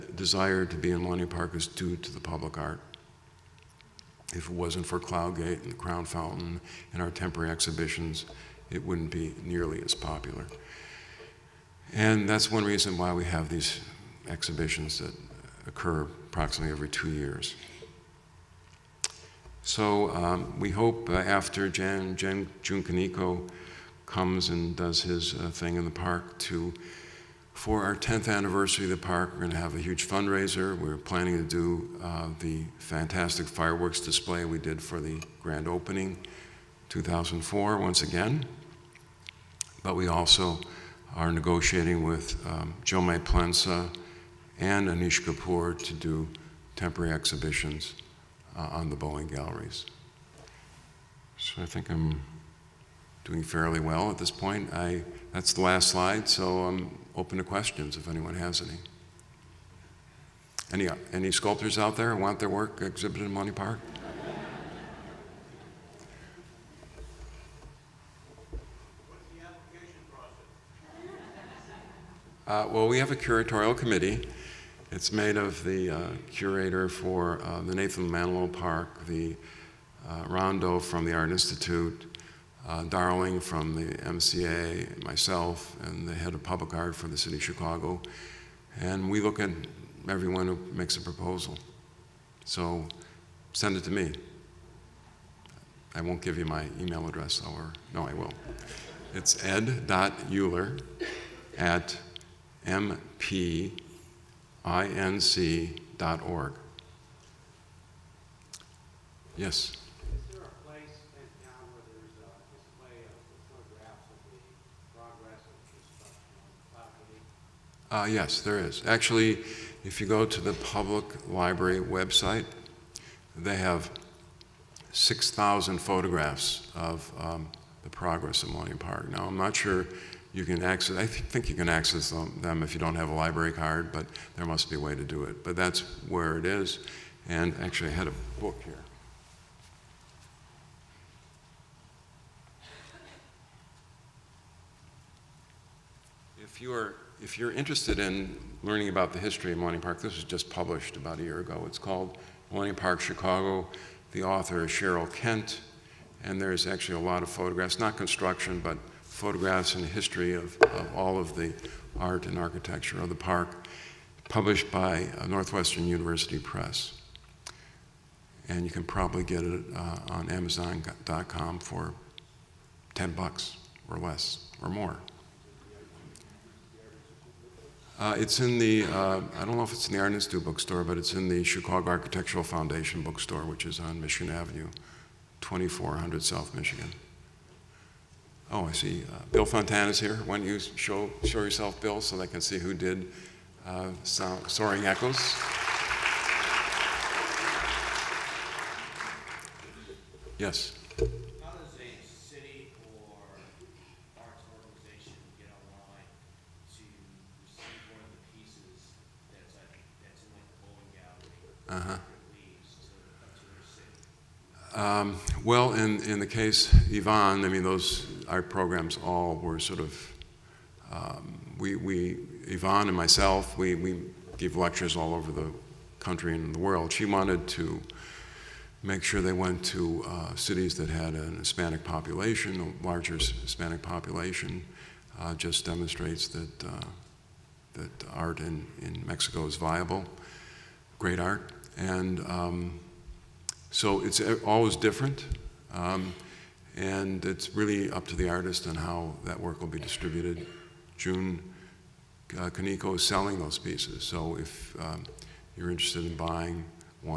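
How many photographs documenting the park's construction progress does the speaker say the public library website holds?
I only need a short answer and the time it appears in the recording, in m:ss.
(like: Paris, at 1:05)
6,000, at 2:04.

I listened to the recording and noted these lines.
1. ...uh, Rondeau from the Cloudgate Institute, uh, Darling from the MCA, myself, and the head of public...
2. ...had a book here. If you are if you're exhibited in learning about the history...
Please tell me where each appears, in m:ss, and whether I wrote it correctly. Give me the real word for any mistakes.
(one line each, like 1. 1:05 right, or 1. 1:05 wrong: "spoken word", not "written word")
1. 1:20 wrong: "Art", not "Cloudgate"
2. 2:17 wrong: "interested", not "exhibited".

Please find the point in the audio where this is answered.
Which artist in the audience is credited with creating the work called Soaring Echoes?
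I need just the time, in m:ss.
3:09.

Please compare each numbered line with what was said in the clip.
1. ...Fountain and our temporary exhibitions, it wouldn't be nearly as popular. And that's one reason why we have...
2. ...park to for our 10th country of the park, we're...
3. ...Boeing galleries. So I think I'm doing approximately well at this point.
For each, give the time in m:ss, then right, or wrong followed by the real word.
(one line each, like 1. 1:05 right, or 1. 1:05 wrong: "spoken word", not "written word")
1. 0:06 right
2. 0:25 wrong: "anniversary", not "country"
3. 0:48 wrong: "fairly", not "approximately".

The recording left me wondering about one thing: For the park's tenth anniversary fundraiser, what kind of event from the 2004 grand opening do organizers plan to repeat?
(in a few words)
fireworks display.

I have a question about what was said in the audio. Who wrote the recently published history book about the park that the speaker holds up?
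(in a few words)
Cheryl Kent.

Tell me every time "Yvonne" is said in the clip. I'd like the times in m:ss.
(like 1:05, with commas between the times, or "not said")
3:36, 3:42.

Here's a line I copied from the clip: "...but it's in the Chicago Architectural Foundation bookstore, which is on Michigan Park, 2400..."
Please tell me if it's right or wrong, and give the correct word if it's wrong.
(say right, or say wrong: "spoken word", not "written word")
wrong: "Avenue", not "Park".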